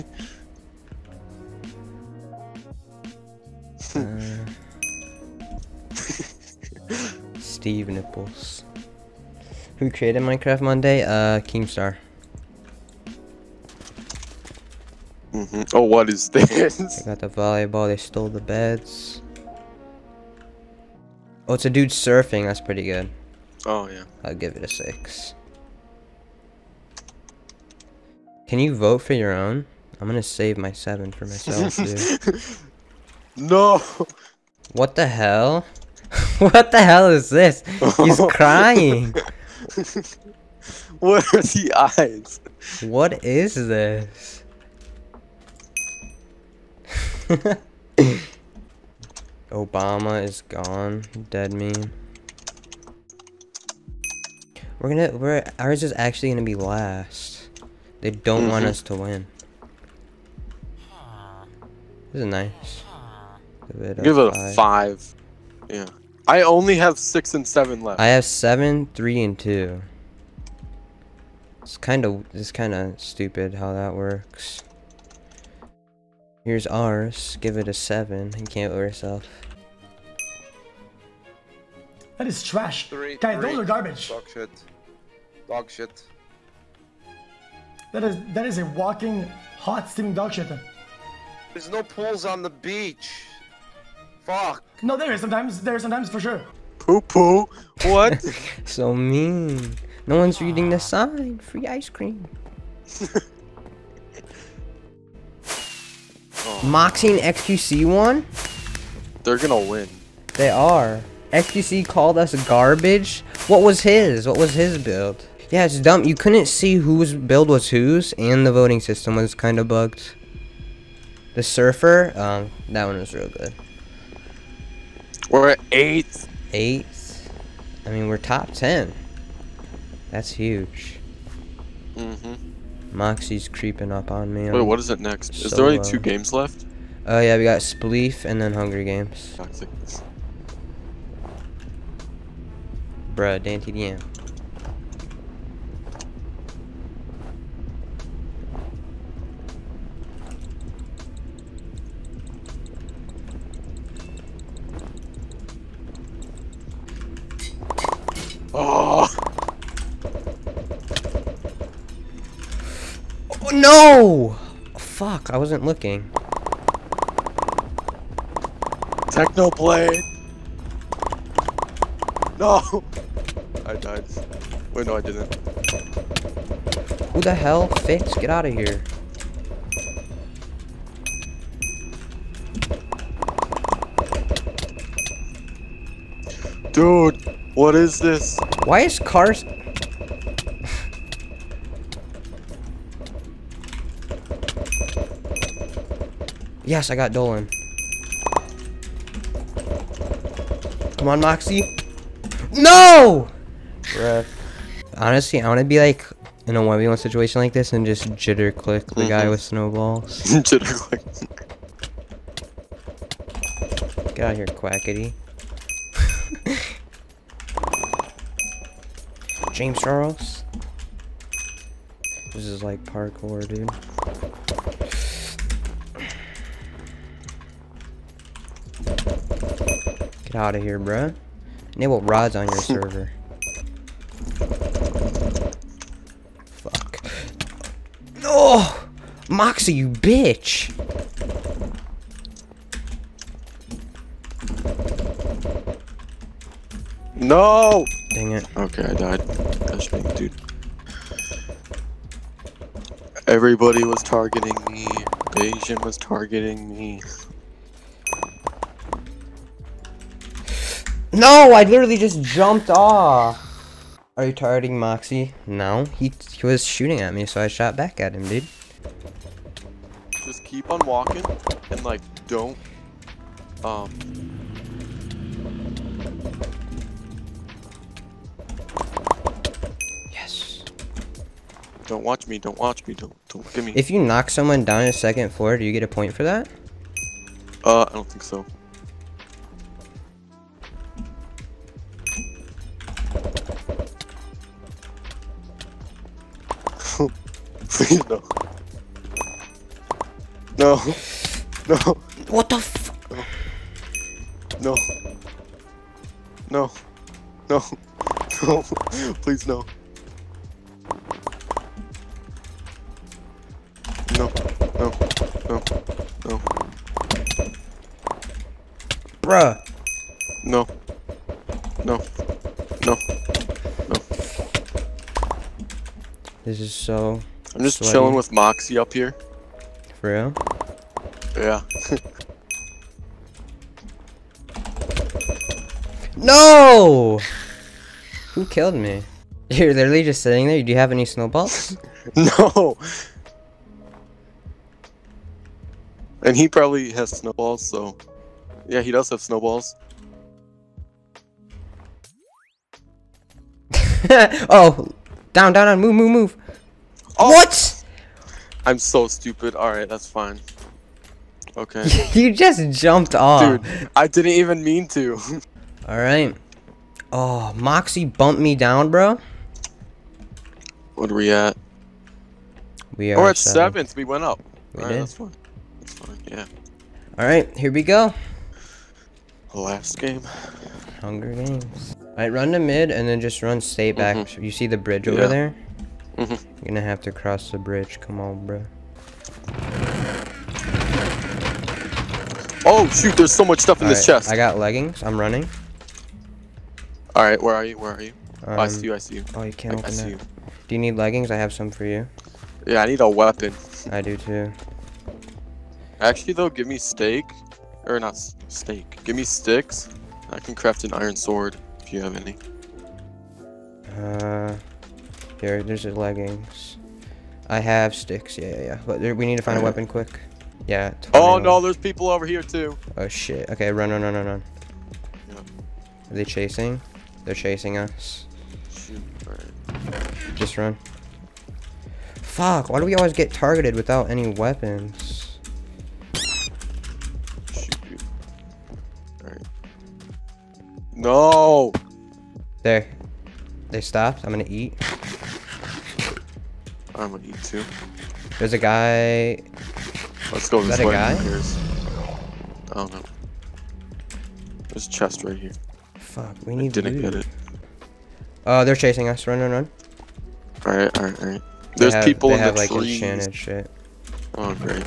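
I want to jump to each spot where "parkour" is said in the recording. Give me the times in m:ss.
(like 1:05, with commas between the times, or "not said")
3:42.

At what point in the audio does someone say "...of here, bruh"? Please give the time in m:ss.
3:50.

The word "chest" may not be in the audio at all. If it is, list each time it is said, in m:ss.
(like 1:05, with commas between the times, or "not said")
6:34, 7:34.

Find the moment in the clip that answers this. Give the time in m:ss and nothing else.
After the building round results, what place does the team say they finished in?
2:05.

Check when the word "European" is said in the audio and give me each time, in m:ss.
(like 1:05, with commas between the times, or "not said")
not said.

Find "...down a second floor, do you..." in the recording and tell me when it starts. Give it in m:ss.
4:44.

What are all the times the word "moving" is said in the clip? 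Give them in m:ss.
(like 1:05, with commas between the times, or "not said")
not said.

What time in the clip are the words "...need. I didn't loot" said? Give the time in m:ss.
7:36.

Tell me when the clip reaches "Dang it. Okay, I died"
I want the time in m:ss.
4:08.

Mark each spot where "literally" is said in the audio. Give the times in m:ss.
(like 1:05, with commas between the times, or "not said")
4:21, 5:39.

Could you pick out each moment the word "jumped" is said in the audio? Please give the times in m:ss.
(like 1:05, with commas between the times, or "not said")
4:22, 6:02.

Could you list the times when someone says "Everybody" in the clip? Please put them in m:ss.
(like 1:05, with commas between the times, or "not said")
4:13.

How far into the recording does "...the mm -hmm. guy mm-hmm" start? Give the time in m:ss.
3:28.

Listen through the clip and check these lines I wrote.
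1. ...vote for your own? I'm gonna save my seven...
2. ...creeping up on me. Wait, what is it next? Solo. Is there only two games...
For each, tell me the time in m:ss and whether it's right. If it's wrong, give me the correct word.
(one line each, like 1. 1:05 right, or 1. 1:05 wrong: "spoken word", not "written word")
1. 0:28 right
2. 2:13 right.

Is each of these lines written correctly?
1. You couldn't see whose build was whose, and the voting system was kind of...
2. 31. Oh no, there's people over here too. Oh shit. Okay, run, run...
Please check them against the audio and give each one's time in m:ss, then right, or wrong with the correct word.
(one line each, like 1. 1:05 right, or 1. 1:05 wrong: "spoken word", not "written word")
1. 1:56 right
2. 7:01 wrong: "21", not "31".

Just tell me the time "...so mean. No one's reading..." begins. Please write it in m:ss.
1:38.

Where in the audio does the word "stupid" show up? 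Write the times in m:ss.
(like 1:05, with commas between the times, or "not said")
1:12, 5:59.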